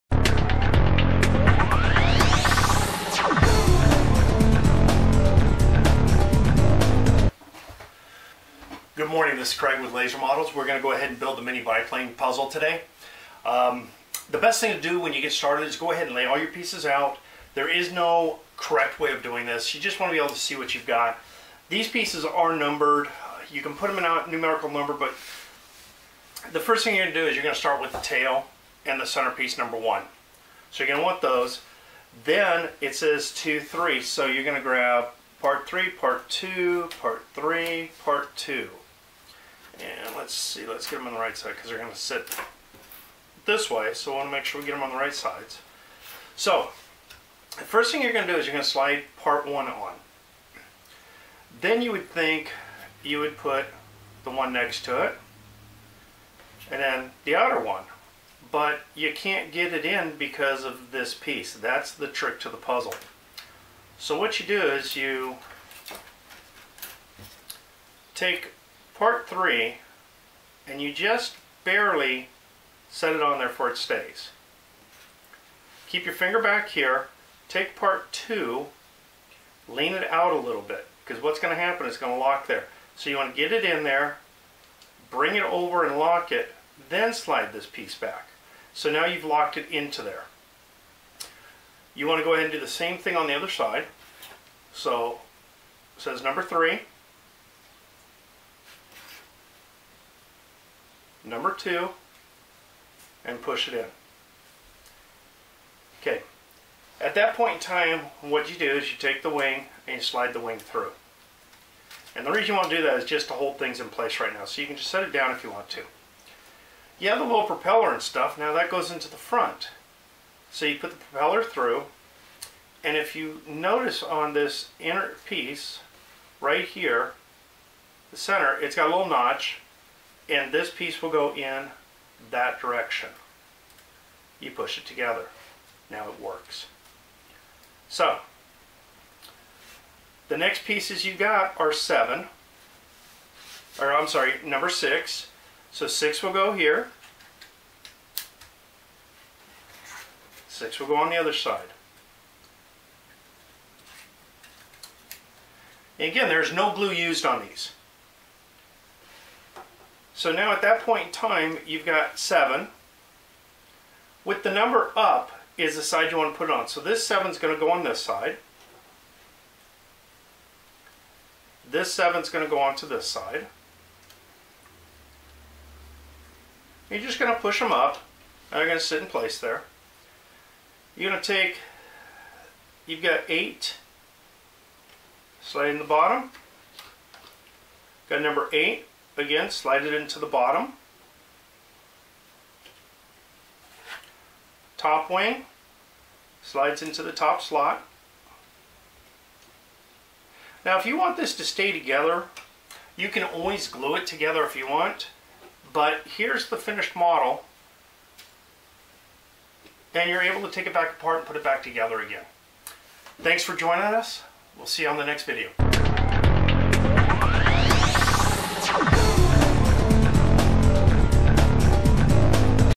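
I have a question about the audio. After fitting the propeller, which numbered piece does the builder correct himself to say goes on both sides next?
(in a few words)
6.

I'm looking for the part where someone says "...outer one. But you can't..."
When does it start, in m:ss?
0:57.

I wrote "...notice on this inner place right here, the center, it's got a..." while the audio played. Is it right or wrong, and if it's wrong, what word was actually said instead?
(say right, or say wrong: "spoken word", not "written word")
wrong: "piece", not "place".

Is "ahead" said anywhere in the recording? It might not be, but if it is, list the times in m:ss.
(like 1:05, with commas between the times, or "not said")
0:10, 0:15, 1:32.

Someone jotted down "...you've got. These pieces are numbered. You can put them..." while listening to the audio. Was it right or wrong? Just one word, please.
right.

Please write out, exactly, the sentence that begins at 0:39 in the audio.
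And let's see, let's get them on the right side because they're going to sit this way.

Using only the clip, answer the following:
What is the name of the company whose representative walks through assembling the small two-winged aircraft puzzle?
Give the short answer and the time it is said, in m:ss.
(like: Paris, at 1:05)
Lazer Models, at 0:09.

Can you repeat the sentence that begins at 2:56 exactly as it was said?
You're just going to push them up.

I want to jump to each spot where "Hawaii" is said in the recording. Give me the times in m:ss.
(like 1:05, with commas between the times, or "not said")
not said.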